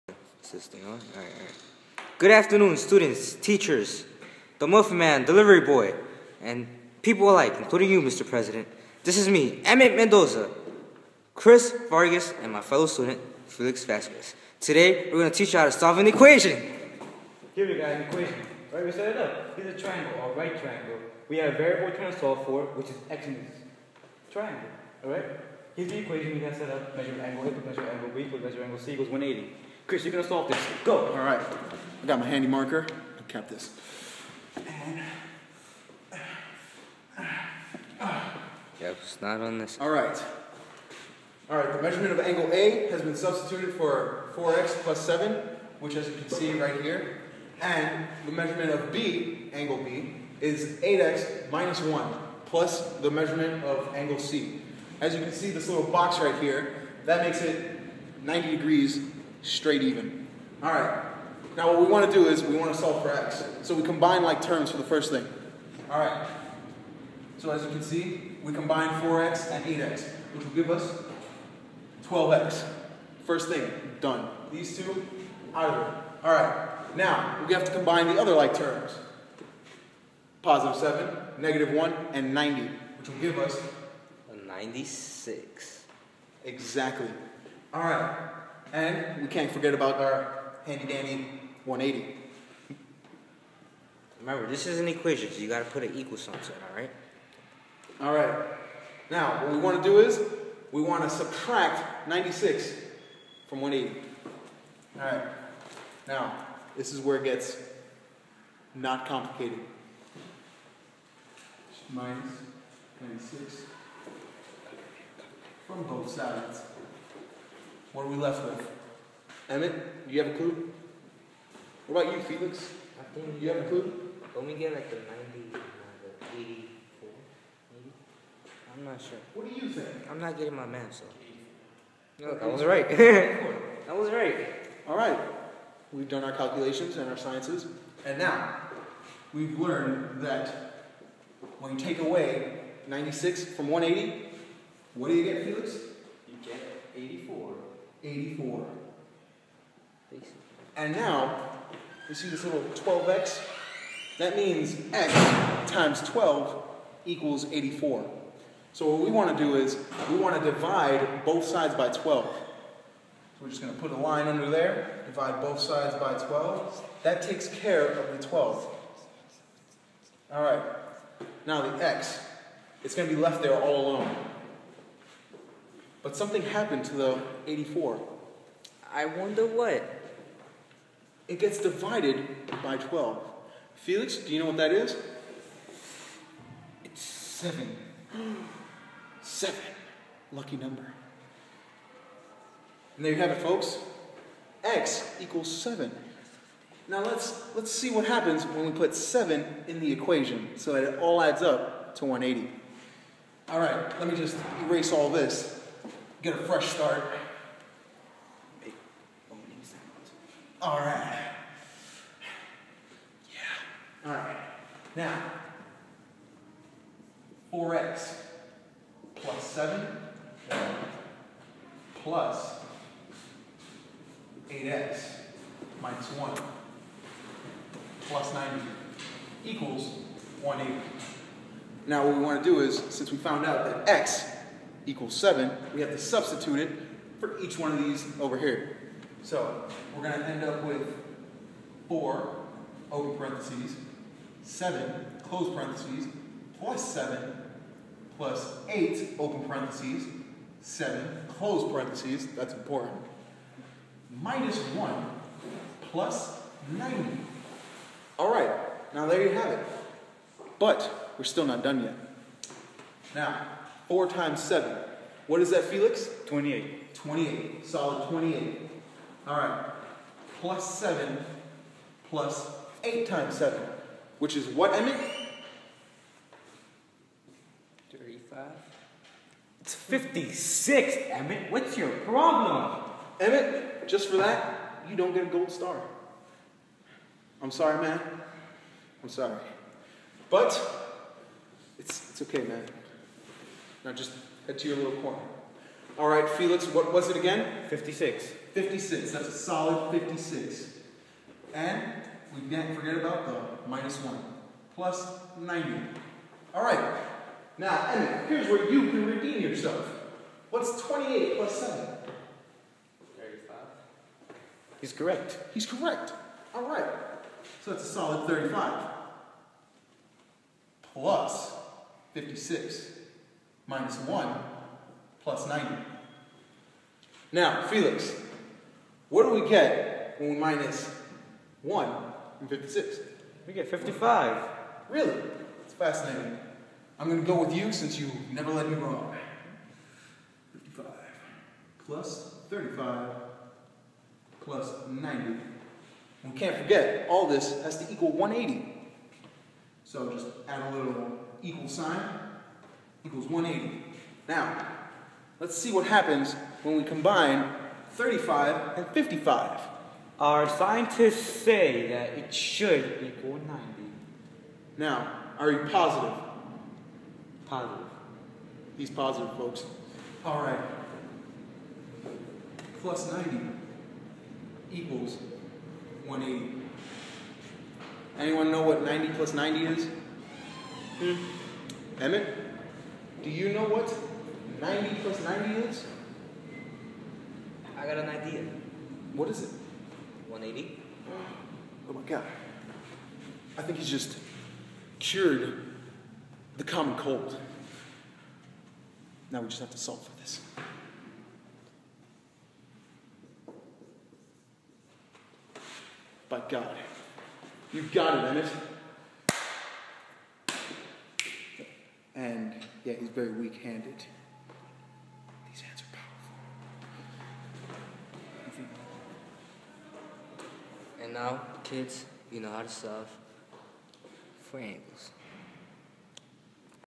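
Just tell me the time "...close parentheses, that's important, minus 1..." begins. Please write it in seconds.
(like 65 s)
251 s.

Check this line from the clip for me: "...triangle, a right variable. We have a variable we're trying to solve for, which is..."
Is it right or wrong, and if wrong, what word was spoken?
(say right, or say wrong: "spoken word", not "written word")
wrong: "triangle", not "variable".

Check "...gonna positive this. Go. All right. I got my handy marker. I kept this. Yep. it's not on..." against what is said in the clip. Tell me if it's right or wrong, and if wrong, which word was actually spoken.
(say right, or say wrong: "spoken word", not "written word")
wrong: "solve", not "positive".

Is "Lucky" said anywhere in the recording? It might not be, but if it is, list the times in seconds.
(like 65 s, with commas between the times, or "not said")
190 s.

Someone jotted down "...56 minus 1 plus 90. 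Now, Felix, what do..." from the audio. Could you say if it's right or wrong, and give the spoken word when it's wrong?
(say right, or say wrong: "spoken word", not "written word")
right.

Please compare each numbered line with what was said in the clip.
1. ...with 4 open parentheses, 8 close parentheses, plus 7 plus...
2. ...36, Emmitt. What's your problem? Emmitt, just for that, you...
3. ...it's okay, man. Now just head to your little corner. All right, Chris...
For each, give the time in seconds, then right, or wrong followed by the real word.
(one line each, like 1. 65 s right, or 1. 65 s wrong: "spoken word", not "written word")
1. 240 s wrong: "7", not "8"
2. 279 s wrong: "56", not "36"
3. 292 s wrong: "Felix", not "Chris".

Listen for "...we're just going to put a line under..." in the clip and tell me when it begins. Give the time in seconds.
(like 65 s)
163 s.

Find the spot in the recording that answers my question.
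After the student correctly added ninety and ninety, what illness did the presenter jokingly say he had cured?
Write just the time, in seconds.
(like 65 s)
396 s.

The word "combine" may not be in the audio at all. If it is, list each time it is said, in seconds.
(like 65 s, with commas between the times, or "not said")
63 s, 68 s, 77 s, 356 s.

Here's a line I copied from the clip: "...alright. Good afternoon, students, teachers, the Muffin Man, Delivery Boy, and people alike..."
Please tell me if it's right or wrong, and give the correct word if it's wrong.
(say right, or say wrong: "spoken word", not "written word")
right.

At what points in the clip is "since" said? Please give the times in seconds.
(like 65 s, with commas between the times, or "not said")
232 s, 337 s.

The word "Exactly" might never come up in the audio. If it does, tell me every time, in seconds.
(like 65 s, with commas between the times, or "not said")
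86 s.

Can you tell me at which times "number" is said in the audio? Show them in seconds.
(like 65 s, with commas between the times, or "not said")
190 s.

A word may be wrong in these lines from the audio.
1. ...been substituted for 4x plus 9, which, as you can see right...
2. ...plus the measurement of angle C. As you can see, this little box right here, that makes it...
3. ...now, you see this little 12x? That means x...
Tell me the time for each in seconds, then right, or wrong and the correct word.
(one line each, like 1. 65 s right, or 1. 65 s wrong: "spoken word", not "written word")
1. 43 s wrong: "7", not "9"
2. 52 s right
3. 150 s right.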